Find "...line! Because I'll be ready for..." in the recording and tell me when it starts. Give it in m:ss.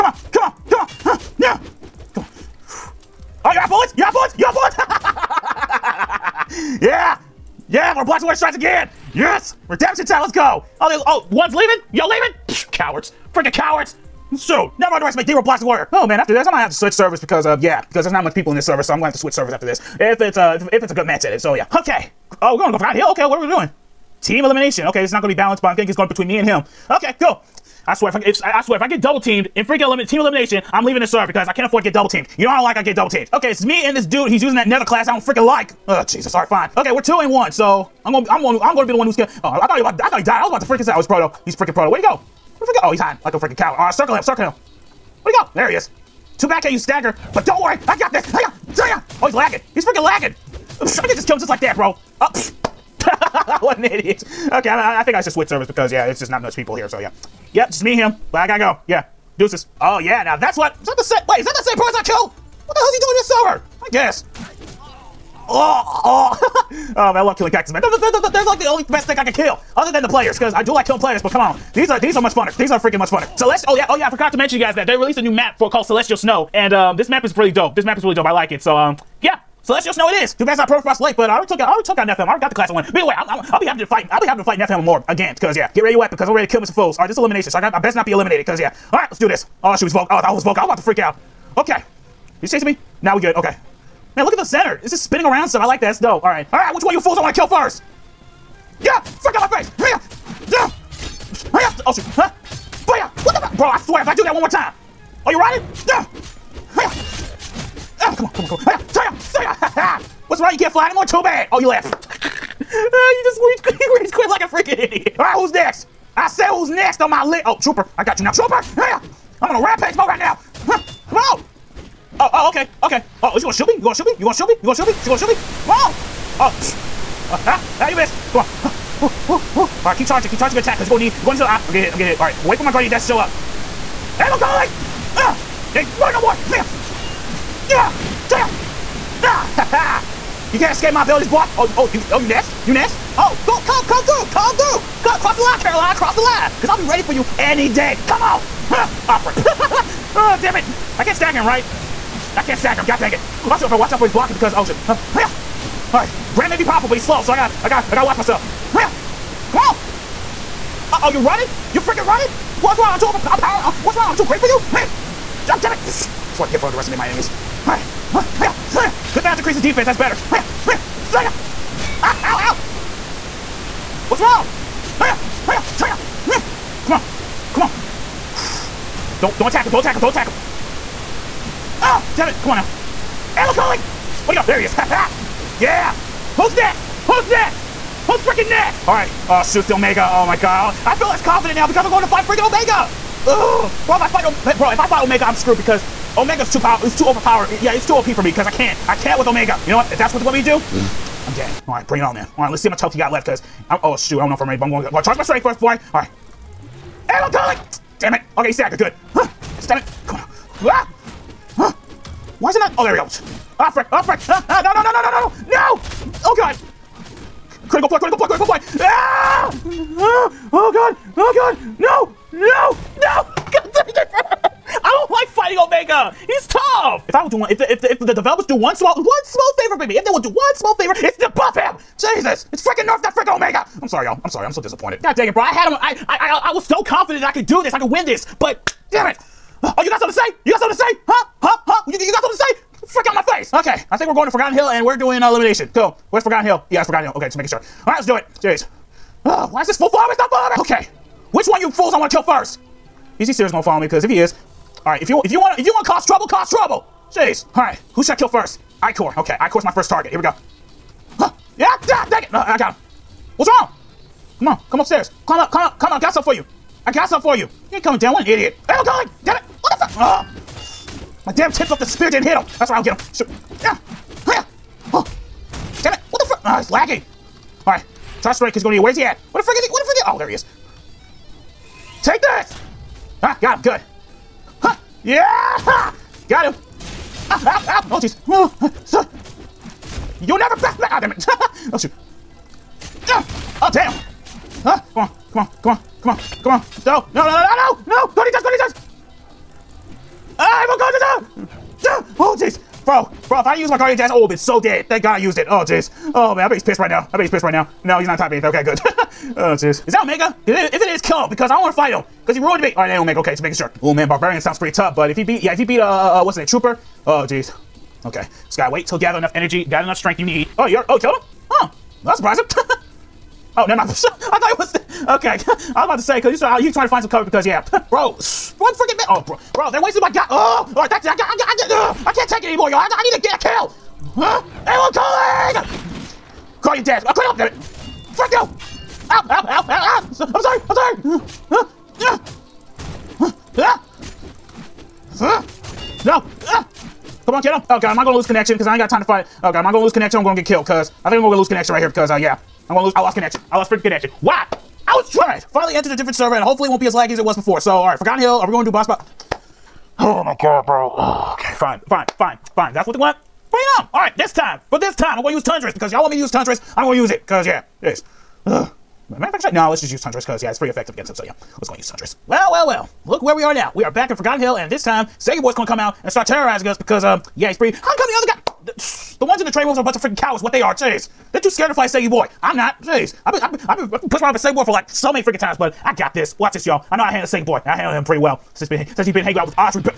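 2:26.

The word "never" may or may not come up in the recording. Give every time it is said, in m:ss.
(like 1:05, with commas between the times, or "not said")
0:14, 4:50, 5:23.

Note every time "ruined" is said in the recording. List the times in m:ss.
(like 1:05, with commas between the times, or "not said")
5:12.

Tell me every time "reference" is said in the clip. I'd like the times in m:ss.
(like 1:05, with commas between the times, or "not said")
not said.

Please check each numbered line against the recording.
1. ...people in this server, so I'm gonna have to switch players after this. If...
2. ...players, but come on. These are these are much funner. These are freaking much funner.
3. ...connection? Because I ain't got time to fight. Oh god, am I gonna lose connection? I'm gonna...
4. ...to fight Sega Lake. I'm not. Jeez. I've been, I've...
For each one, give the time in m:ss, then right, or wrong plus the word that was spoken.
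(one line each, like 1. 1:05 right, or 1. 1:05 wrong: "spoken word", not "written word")
1. 0:18 wrong: "servers", not "players"
2. 1:10 right
3. 5:48 right
4. 6:21 wrong: "Boy", not "Lake".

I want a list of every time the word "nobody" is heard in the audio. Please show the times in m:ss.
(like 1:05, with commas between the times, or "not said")
3:45.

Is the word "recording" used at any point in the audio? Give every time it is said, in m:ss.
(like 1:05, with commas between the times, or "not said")
not said.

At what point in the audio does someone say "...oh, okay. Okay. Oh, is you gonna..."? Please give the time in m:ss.
2:02.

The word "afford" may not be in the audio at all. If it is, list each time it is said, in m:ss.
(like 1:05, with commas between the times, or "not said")
0:31.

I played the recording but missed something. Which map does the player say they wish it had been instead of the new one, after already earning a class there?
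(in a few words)
Pro Frost Lake.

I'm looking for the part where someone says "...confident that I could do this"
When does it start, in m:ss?
3:56.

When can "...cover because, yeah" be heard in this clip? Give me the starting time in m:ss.
5:27.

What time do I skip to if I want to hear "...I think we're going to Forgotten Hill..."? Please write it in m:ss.
4:03.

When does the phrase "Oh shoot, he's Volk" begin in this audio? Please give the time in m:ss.
1:29.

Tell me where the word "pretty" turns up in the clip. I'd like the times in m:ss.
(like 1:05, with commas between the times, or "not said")
5:14, 6:10, 6:17, 6:28.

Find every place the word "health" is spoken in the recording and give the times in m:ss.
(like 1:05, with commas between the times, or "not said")
3:22.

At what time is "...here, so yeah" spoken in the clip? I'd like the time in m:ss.
0:56.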